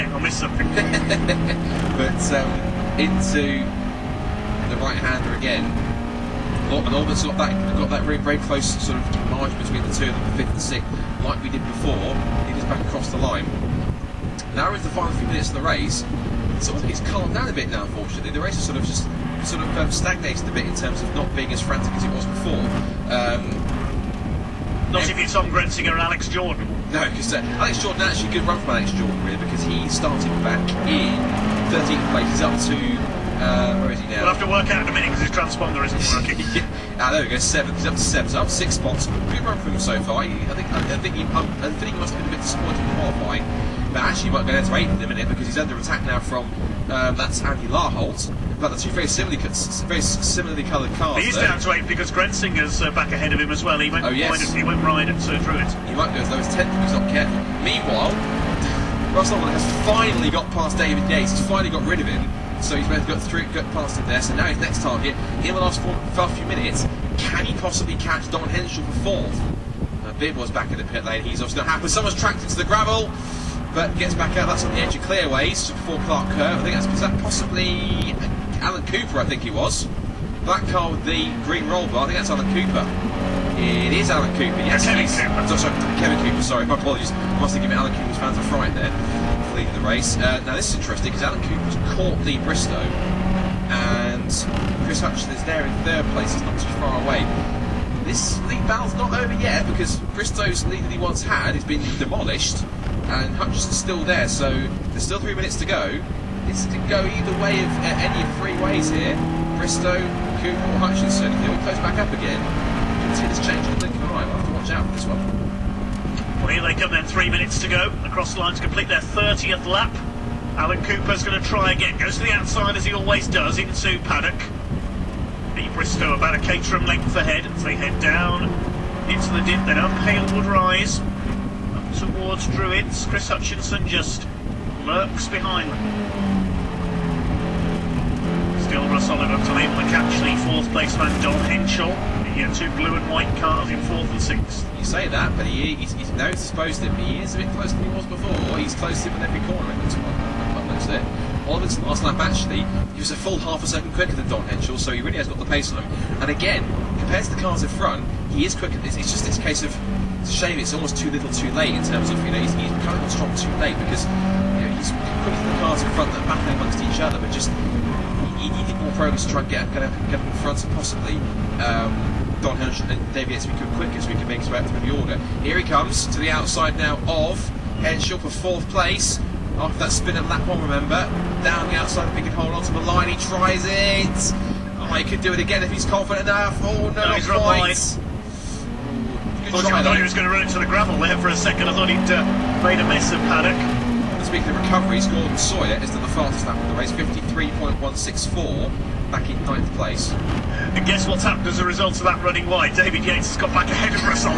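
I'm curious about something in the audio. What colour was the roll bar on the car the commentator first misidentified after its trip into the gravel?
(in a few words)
Green.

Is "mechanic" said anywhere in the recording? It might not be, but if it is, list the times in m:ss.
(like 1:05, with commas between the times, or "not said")
not said.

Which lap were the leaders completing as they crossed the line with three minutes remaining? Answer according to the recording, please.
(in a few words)
30th.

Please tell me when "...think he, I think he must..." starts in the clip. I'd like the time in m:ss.
0:40.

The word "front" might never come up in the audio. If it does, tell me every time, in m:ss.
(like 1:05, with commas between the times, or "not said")
2:37, 2:45, 2:50.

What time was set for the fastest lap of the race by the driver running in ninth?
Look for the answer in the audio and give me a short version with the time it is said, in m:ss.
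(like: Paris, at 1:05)
53.164, at 3:16.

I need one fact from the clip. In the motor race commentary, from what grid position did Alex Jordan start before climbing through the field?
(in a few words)
13th.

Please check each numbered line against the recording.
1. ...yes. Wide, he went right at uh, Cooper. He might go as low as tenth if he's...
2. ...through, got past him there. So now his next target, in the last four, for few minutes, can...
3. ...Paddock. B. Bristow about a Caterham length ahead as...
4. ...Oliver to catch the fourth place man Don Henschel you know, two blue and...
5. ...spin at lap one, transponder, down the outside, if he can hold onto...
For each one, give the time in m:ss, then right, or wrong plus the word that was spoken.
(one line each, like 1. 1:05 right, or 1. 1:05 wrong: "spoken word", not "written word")
1. 0:54 wrong: "Druitt", not "Cooper"
2. 1:03 right
3. 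2:03 right
4. 2:19 right
5. 2:59 wrong: "remember", not "transponder".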